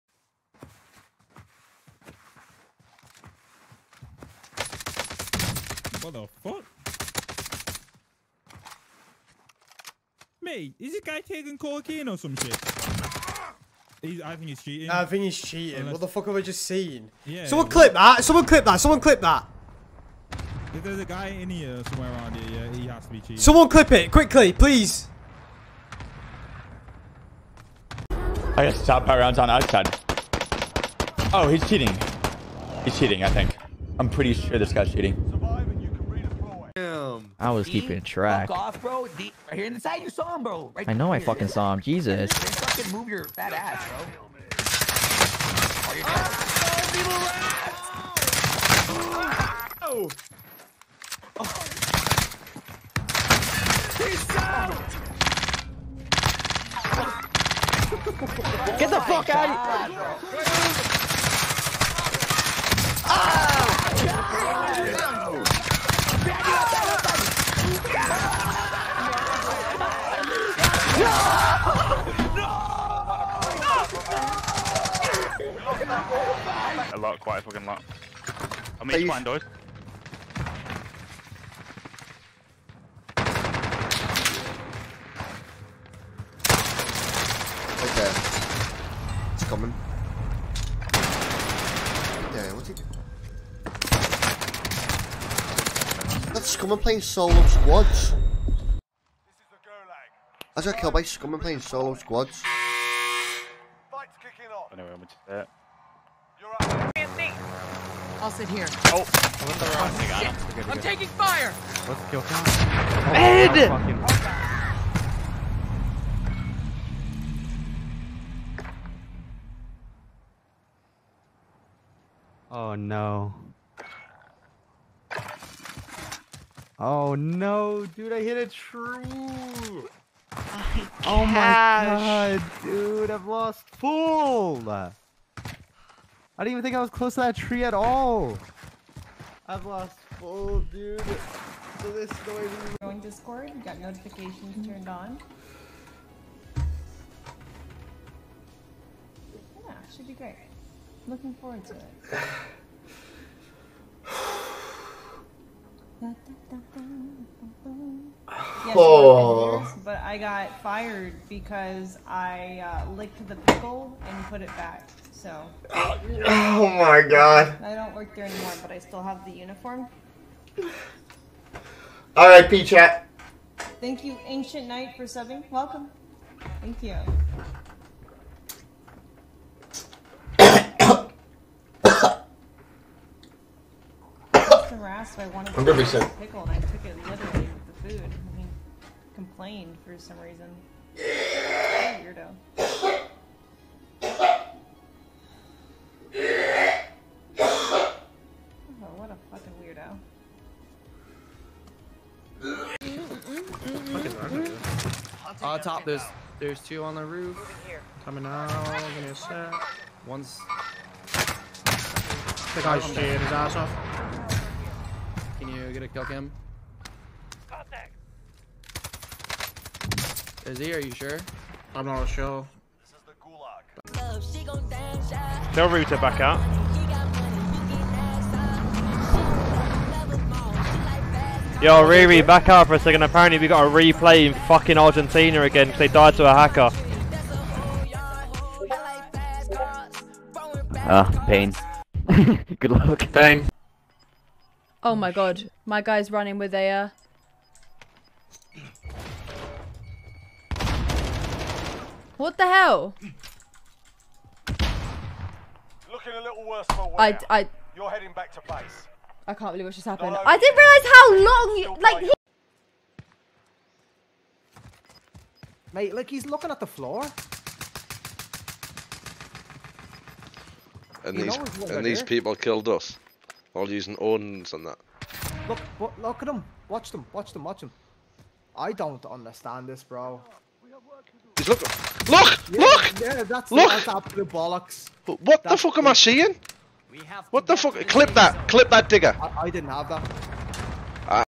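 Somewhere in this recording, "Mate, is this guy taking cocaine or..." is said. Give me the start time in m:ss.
0:10.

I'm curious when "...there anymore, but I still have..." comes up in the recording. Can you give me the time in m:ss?
2:48.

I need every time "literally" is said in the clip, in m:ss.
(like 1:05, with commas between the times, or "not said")
3:07.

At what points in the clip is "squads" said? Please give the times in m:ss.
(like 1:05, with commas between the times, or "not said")
1:37, 1:41.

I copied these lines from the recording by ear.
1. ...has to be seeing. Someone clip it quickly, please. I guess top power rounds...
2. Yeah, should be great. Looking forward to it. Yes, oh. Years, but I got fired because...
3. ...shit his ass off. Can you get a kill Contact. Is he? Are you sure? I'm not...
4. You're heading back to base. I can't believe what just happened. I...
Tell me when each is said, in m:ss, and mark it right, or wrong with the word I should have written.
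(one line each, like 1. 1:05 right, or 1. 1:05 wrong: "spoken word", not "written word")
1. 0:22 wrong: "cheating", not "seeing"
2. 2:29 right
3. 3:32 right
4. 4:17 right.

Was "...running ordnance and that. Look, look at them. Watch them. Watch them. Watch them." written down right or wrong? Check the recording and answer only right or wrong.
wrong.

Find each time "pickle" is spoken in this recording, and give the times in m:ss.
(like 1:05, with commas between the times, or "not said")
2:43, 3:06.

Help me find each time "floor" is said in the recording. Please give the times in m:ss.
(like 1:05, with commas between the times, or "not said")
4:26.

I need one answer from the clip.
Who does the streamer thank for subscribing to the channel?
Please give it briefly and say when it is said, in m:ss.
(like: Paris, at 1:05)
Ancient Knight, at 2:54.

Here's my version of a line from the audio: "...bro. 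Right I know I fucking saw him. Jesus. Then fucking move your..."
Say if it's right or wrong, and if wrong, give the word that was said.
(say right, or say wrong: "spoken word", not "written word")
right.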